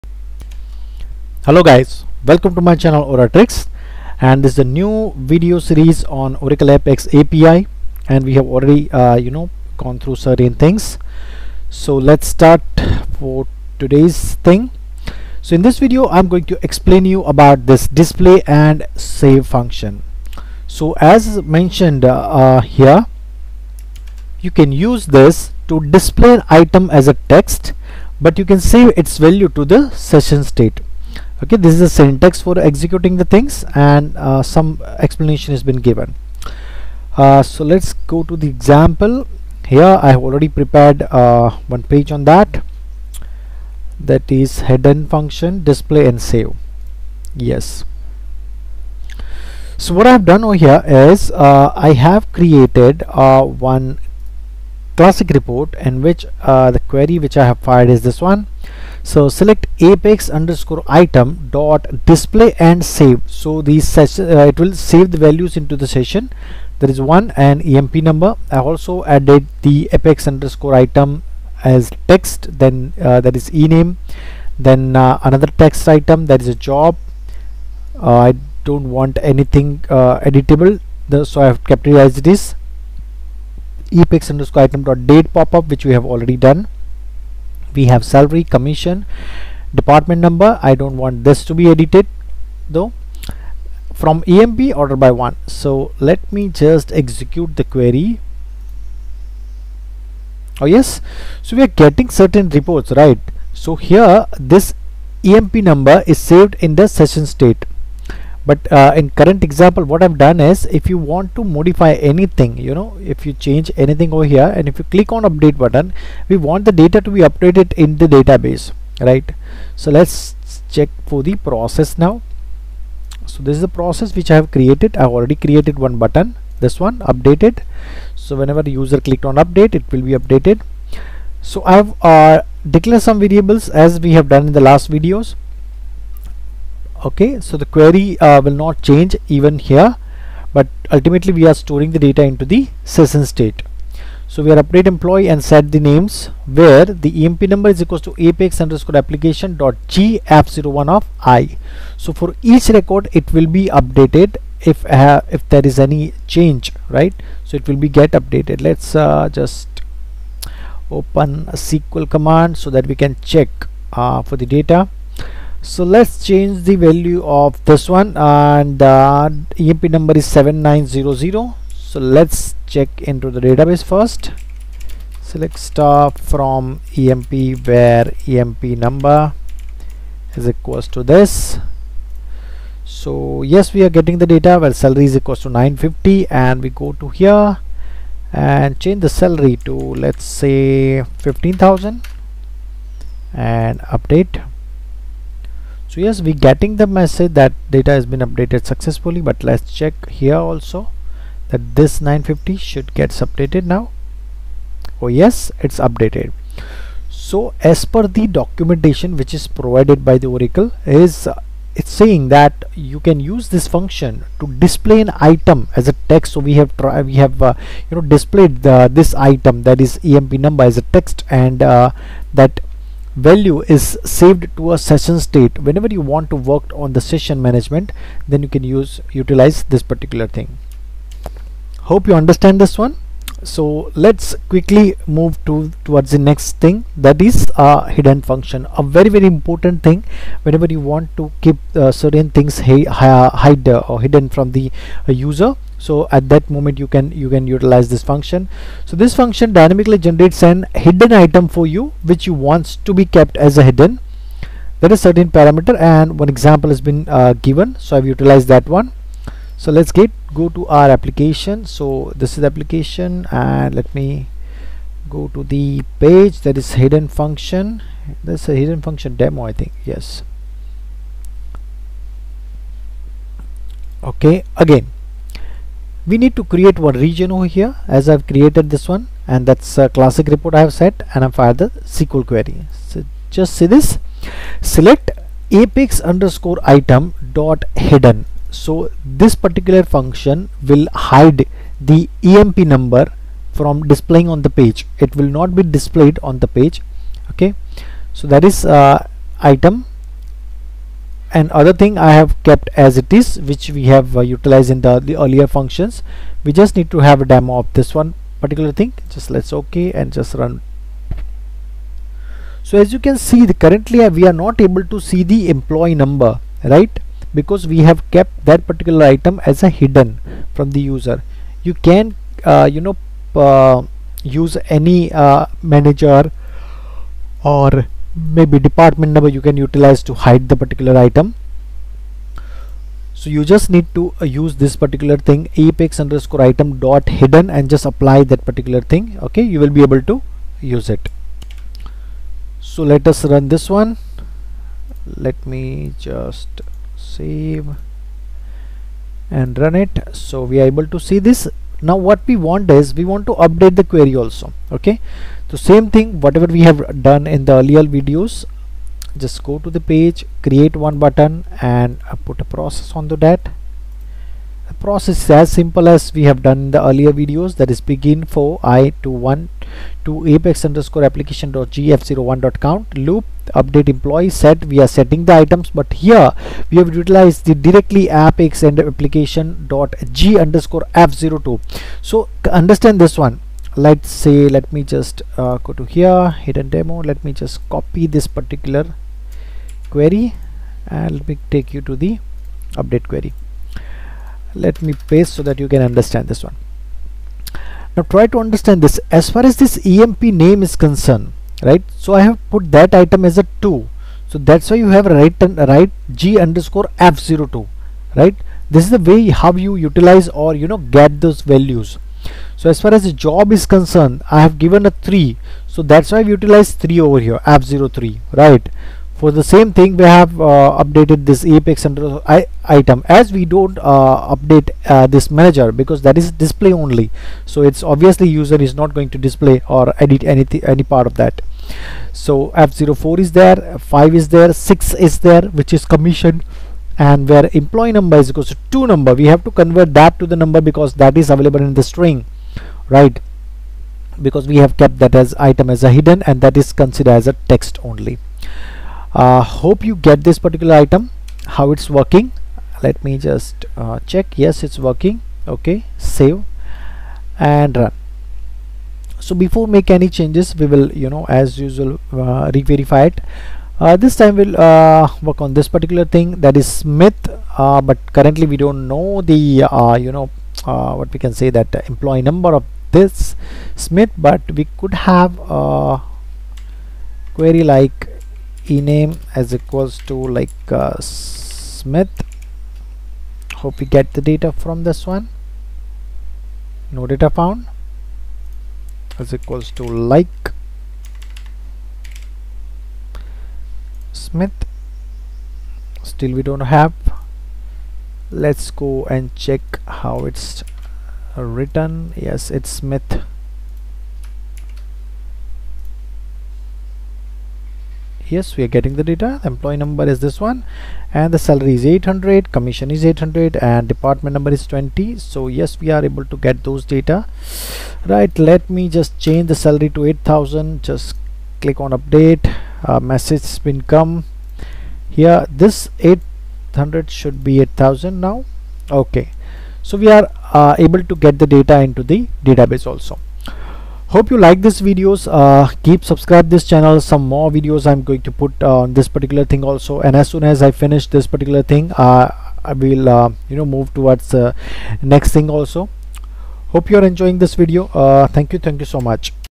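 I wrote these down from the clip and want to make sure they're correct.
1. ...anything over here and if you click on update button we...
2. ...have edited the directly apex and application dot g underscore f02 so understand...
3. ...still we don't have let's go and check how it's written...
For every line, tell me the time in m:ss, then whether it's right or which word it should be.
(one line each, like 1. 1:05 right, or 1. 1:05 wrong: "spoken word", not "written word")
1. 1:53 right
2. 6:16 wrong: "utilized", not "edited"
3. 8:16 right.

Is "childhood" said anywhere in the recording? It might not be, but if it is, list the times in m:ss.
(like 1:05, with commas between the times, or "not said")
not said.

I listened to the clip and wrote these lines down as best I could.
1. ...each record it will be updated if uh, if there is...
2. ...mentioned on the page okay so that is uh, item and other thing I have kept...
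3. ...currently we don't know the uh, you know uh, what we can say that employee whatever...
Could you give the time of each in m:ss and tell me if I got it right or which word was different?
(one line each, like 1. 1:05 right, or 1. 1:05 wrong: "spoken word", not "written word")
1. 2:32 right
2. 4:55 wrong: "displayed", not "mentioned"
3. 7:48 wrong: "number", not "whatever".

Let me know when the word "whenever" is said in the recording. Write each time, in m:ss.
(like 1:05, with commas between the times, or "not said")
2:08, 3:45, 4:00.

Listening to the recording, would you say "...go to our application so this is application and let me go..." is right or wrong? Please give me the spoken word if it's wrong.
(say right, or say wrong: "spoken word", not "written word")
right.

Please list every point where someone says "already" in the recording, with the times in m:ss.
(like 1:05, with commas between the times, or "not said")
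0:08, 0:40, 1:26, 2:05.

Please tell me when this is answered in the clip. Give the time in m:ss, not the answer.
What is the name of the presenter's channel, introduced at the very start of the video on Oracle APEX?
0:03.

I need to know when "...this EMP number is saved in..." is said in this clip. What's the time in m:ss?
1:44.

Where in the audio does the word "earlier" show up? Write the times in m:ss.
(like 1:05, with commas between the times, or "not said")
5:05, 5:57, 6:06.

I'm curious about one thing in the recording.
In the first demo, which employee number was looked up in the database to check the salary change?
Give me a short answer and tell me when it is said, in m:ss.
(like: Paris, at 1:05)
7900, at 2:50.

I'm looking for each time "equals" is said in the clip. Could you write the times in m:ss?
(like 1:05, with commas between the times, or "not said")
2:27, 3:00, 3:05, 7:18, 7:59, 8:09.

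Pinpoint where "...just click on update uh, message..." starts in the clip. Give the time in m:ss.
8:40.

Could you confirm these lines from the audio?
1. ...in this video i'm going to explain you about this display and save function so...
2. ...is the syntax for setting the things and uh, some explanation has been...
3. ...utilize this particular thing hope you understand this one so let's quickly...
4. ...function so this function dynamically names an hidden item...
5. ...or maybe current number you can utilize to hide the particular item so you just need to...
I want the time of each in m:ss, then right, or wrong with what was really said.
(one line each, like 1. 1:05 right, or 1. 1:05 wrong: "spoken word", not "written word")
1. 0:15 right
2. 0:31 wrong: "executing", not "setting"
3. 3:49 right
4. 4:08 wrong: "generates", not "names"
5. 5:27 wrong: "department", not "current".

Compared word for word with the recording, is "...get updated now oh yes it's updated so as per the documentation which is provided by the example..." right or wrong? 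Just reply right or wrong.
wrong.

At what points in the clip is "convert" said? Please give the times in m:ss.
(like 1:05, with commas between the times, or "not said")
7:19.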